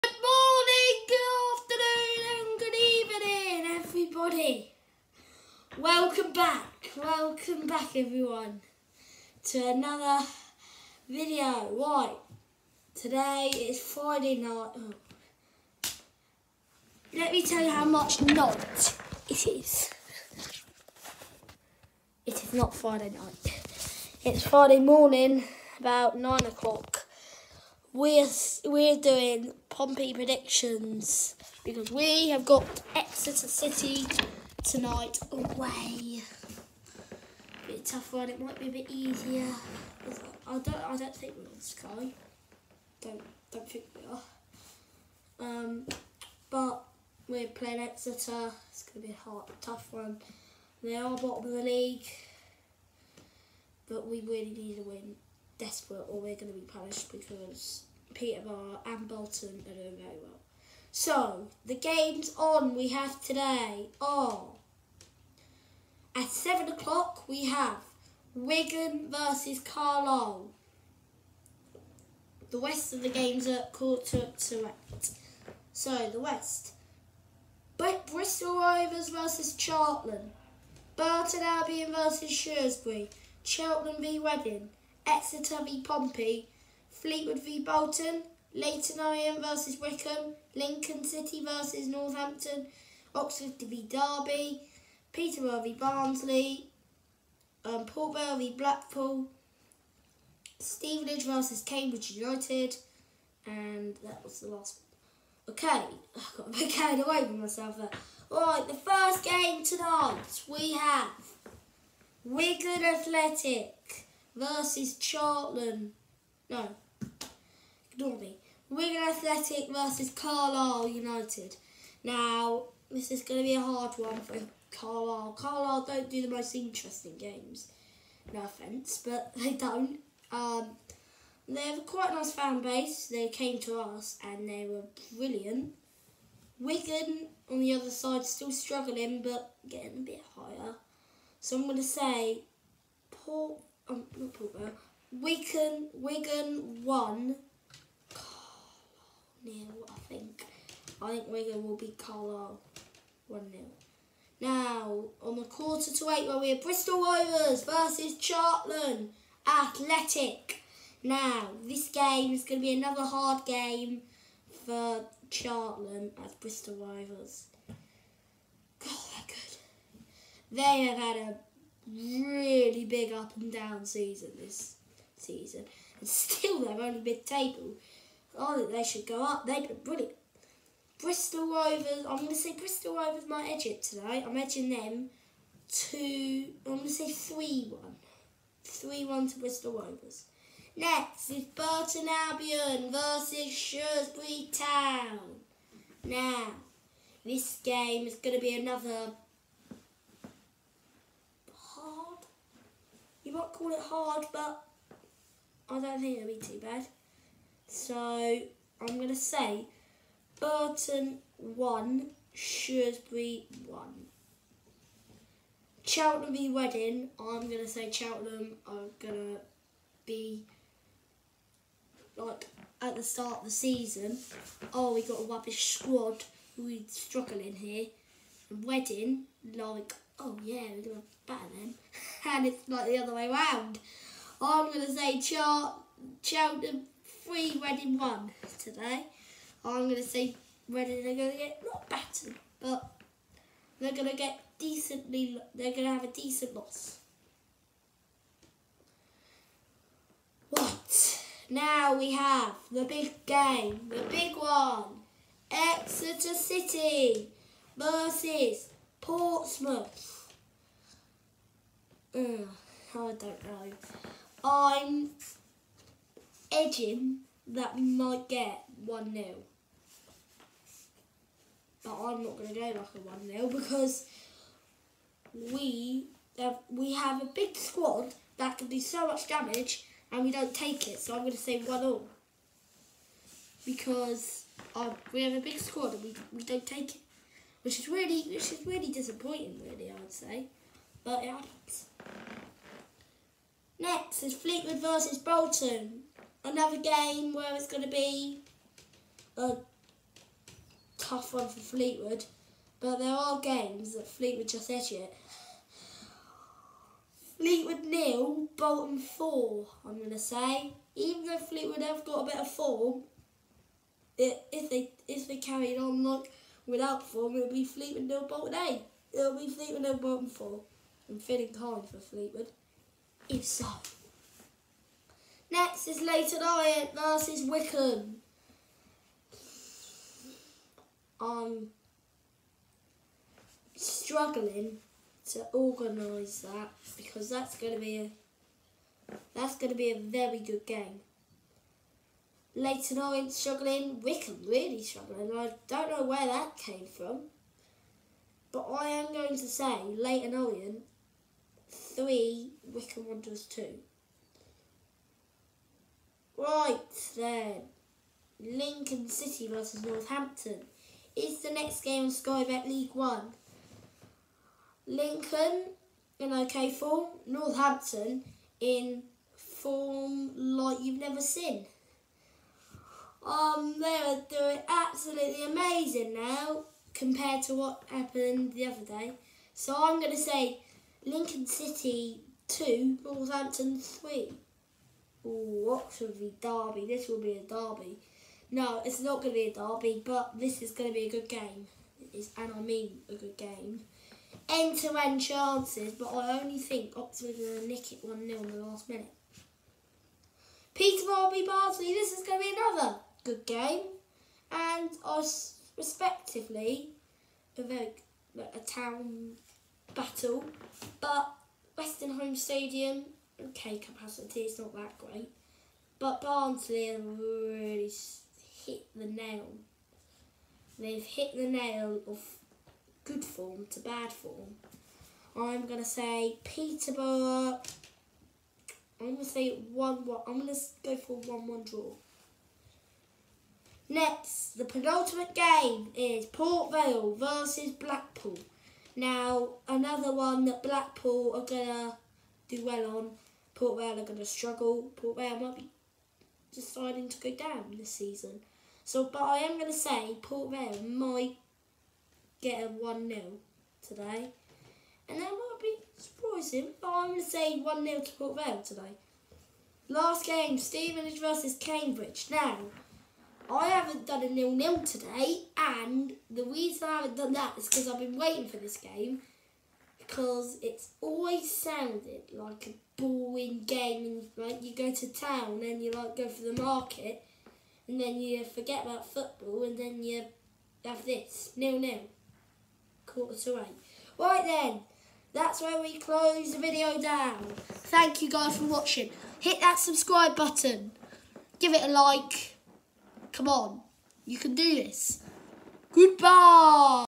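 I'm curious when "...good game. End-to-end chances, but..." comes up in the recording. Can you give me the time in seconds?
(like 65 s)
393 s.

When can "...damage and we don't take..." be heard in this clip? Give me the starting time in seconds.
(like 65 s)
279 s.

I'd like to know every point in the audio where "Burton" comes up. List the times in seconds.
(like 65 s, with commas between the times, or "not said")
80 s, 191 s, 210 s.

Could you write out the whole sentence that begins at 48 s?
It's gonna be a hard, tough one.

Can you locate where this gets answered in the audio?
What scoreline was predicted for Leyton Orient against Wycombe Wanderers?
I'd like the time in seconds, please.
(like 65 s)
349 s.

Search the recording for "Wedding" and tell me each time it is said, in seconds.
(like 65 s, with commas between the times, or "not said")
216 s, 228 s, 237 s.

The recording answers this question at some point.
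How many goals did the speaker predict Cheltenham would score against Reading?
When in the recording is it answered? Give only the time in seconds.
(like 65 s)
236 s.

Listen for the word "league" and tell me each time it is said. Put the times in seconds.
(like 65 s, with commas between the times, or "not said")
51 s, 362 s.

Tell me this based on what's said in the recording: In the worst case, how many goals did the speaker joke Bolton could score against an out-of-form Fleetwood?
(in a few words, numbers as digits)
8.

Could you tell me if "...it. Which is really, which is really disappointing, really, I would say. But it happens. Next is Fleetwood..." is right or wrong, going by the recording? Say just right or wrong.
right.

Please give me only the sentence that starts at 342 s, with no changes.
Leyton Orient struggling, Wycombe really struggling.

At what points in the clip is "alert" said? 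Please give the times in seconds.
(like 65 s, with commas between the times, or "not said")
not said.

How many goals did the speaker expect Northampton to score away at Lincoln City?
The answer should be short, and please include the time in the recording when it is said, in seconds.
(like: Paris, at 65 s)
3, at 383 s.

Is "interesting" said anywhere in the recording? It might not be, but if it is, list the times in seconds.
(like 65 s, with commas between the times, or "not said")
126 s.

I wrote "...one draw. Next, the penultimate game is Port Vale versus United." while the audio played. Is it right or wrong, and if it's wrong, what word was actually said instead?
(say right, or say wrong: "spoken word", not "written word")
wrong: "Blackpool", not "United".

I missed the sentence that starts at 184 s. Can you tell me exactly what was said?
I'm edging them two, I'm going to say 3-1.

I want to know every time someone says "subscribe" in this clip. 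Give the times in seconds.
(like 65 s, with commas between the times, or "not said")
489 s.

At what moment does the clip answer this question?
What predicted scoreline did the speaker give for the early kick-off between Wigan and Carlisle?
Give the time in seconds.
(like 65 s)
151 s.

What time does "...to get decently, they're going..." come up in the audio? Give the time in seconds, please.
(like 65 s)
244 s.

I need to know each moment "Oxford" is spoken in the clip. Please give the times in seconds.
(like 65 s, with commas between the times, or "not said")
93 s, 385 s, 396 s.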